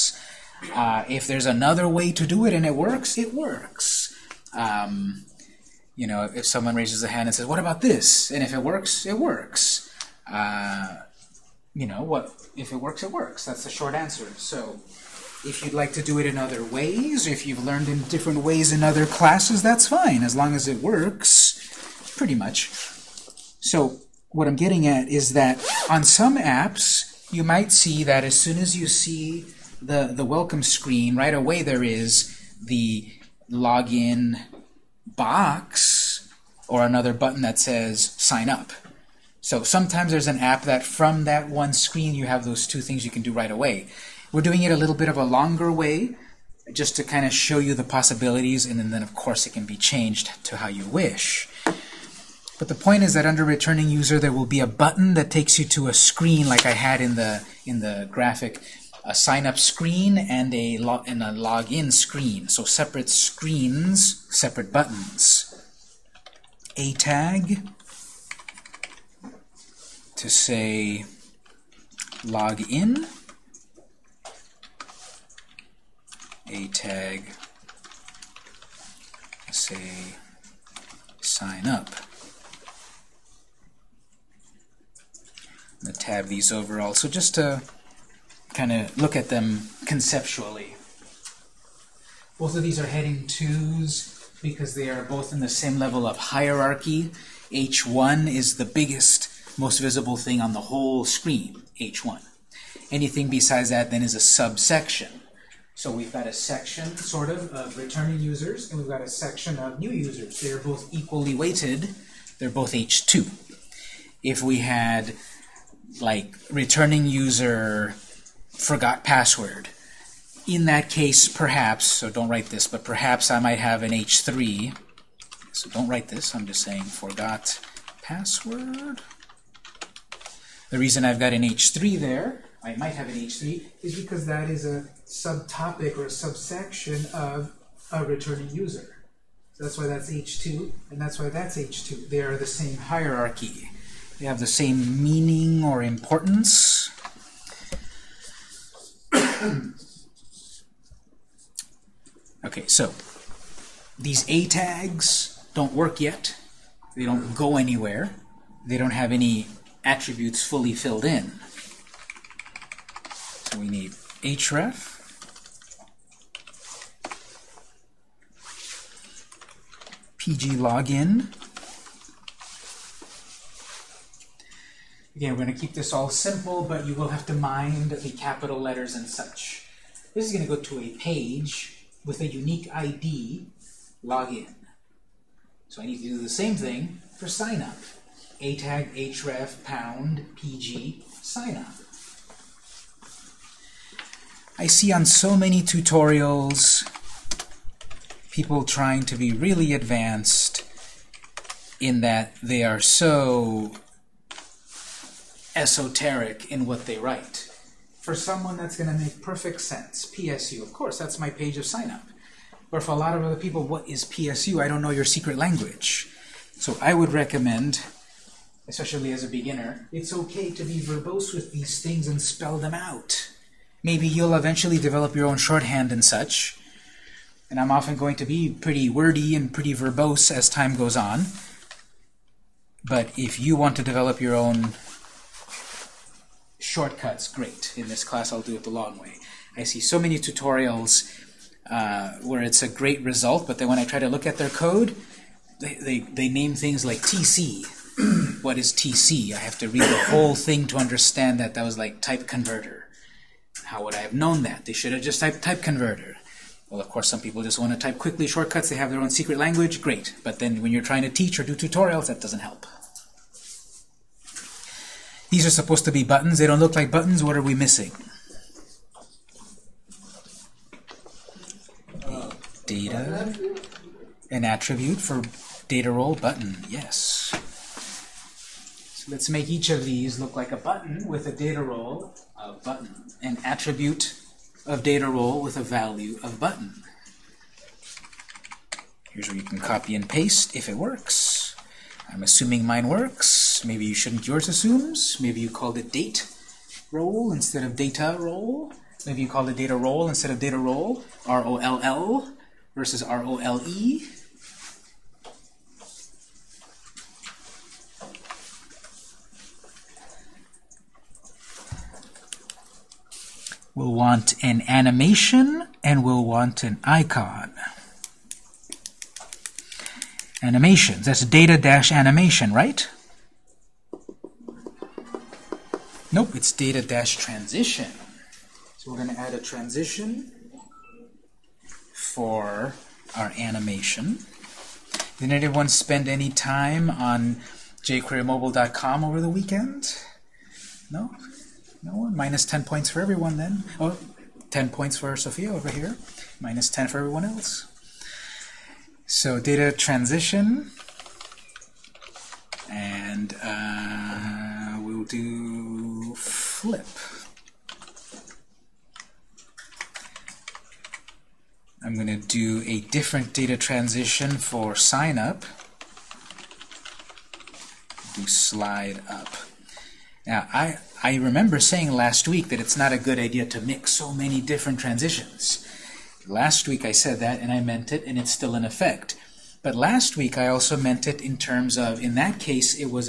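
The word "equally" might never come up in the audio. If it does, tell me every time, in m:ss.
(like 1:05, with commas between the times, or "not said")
1:50.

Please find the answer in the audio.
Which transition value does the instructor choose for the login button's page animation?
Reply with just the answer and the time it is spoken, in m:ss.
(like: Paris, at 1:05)
flip, at 5:56.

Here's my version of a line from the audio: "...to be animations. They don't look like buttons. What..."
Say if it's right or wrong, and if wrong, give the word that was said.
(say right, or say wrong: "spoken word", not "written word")
wrong: "buttons", not "animations".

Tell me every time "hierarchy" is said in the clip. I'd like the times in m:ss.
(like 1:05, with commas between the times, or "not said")
1:36, 2:22.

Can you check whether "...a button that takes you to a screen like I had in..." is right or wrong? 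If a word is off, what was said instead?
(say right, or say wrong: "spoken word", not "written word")
right.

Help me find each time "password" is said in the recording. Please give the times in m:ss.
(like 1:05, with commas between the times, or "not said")
1:59, 2:08.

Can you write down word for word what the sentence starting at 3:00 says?
This is going to go to a page with a unique ID, login.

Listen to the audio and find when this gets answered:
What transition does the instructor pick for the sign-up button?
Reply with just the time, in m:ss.
6:08.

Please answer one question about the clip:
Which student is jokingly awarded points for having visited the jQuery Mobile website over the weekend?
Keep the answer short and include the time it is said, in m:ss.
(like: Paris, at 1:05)
Sophia, at 5:45.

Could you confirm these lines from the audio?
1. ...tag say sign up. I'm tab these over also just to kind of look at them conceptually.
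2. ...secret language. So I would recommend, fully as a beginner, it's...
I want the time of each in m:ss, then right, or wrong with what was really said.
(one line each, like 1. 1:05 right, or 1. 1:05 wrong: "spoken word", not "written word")
1. 1:16 right
2. 3:35 wrong: "especially", not "fully".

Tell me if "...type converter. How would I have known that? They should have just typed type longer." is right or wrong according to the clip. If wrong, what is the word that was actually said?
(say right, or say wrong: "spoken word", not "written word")
wrong: "converter", not "longer".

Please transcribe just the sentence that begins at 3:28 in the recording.
For someone, that's going to make perfect sense.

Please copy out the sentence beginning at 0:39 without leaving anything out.
So sometimes there's an app that from that one screen you have those two things you can do right away.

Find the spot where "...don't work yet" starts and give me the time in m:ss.
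2:35.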